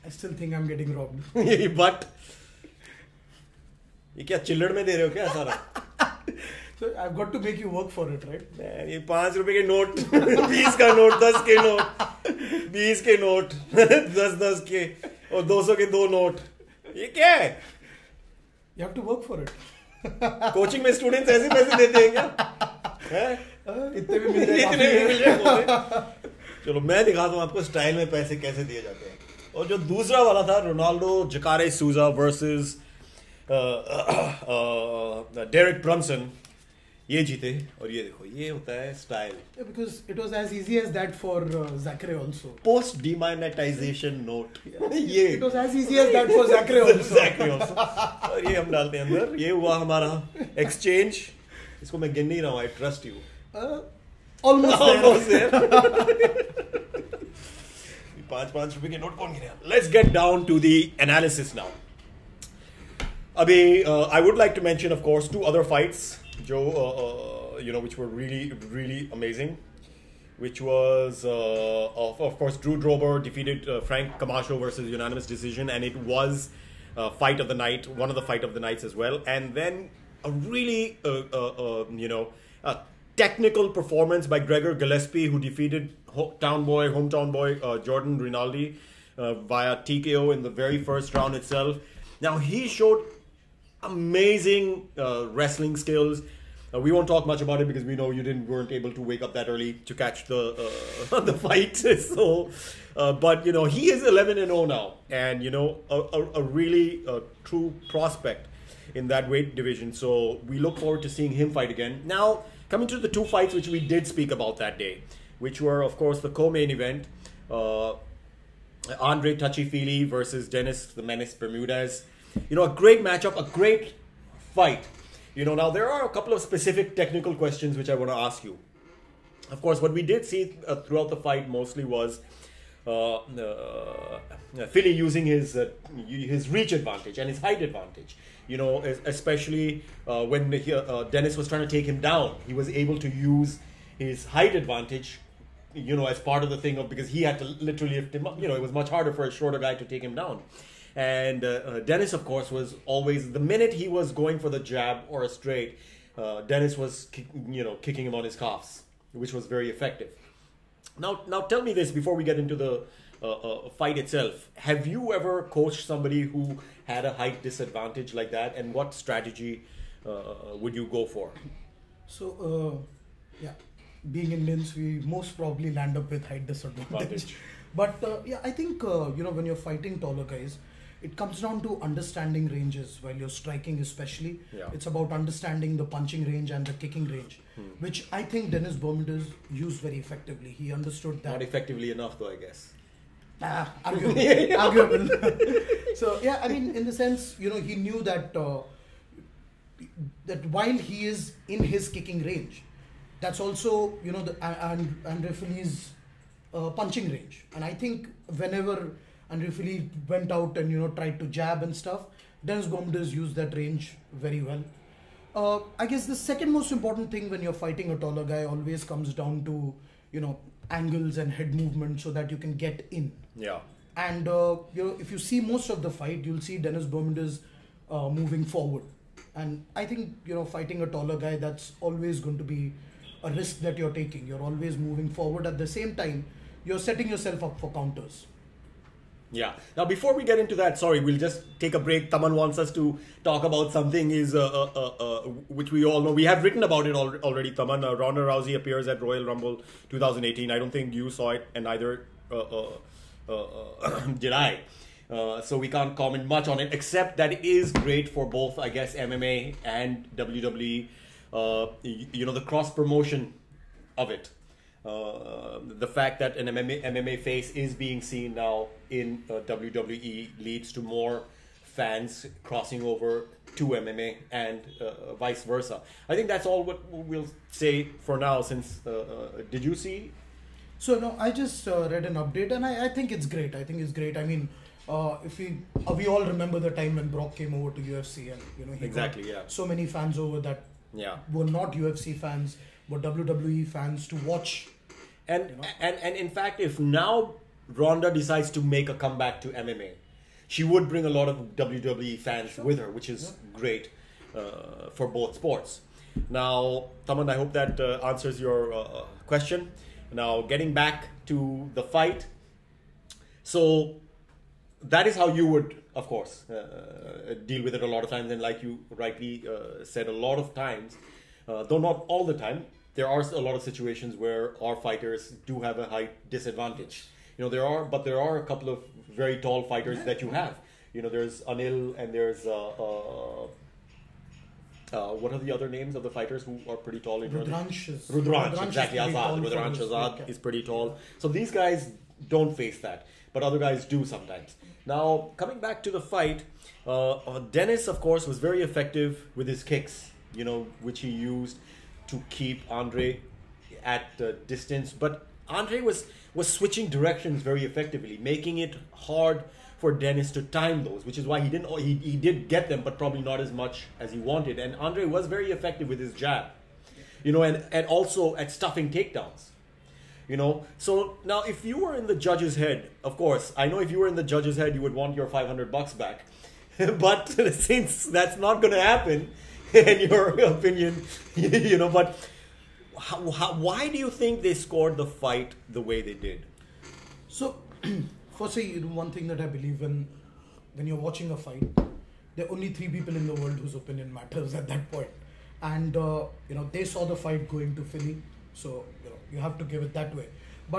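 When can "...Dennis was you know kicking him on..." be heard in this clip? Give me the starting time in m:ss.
2:36.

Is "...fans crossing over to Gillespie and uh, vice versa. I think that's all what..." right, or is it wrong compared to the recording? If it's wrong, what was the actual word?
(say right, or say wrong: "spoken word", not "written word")
wrong: "MMA", not "Gillespie".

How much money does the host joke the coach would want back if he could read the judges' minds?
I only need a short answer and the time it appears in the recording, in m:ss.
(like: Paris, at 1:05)
500 bucks, at 6:15.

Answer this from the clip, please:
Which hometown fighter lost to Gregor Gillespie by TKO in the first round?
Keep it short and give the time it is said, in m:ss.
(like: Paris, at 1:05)
Jordan Rinaldi, at 1:27.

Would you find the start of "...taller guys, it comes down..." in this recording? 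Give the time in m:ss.
2:59.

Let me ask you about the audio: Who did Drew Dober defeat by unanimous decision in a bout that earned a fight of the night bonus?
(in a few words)
Frank Camacho.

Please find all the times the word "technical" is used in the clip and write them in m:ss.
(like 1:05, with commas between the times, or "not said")
1:23, 2:06.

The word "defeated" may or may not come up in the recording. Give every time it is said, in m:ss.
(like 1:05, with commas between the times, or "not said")
1:13, 1:25.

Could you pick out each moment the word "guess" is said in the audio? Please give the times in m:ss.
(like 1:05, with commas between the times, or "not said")
3:12, 3:35, 4:18.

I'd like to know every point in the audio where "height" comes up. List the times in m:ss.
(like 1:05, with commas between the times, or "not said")
2:17, 2:24, 2:47, 2:56, 5:25.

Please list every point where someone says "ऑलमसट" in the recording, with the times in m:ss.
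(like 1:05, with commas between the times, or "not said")
0:54.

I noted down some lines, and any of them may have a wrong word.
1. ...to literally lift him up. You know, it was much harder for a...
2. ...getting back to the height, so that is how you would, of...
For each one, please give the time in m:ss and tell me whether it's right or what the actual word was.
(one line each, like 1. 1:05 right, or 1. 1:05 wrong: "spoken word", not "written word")
1. 2:27 right
2. 5:10 wrong: "fight", not "height".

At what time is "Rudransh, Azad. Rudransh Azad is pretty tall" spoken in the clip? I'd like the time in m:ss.
5:38.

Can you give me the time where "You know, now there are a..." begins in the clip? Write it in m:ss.
2:05.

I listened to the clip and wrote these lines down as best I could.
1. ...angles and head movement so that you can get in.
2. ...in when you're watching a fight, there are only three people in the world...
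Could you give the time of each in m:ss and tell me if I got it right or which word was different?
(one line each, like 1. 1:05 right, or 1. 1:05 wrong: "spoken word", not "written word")
1. 3:40 right
2. 6:29 right.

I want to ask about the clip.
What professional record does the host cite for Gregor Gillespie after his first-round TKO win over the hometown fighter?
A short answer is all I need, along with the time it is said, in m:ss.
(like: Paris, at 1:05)
11-0, at 1:44.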